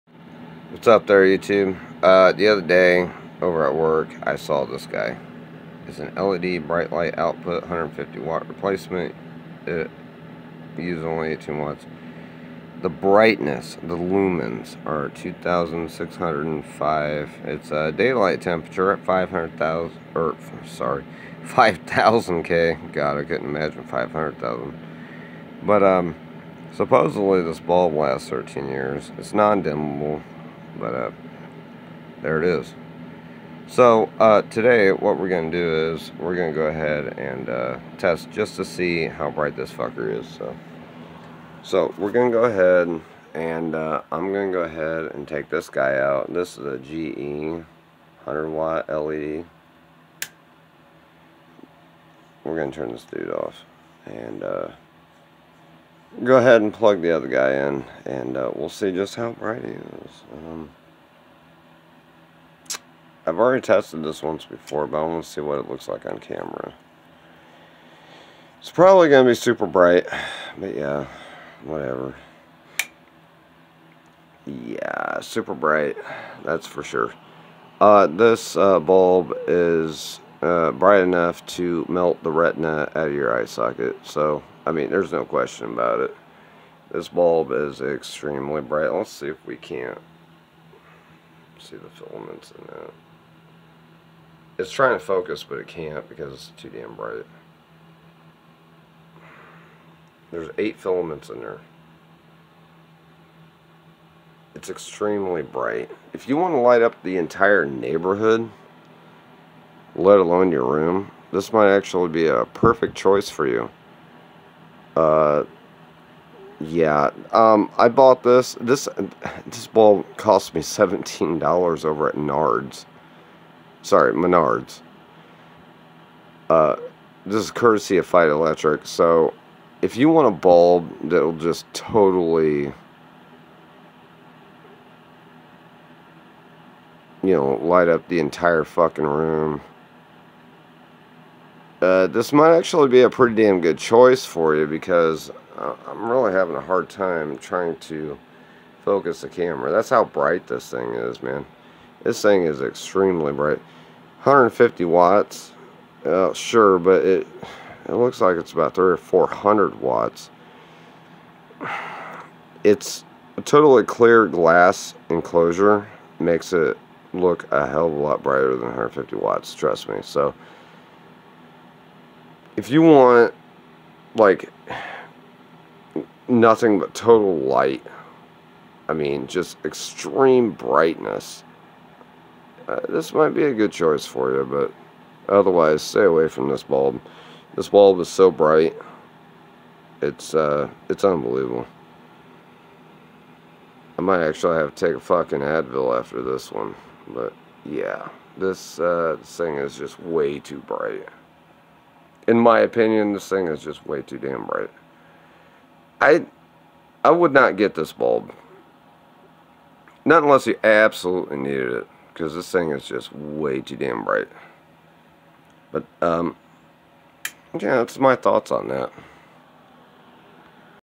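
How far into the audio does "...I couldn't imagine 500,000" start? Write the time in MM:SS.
00:23.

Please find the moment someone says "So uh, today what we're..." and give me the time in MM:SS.
00:33.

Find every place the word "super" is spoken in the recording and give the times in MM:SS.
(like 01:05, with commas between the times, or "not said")
01:09, 01:15.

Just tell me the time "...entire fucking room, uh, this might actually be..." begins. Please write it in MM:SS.
02:18.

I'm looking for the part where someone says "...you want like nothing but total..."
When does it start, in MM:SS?
02:52.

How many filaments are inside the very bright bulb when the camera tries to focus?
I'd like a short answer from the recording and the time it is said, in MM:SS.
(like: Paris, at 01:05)
8, at 01:40.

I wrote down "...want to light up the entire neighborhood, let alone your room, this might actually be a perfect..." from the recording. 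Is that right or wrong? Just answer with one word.
right.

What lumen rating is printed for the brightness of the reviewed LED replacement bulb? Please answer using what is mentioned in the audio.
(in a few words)
2,605.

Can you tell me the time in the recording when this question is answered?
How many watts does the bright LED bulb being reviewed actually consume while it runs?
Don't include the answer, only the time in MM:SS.
00:11.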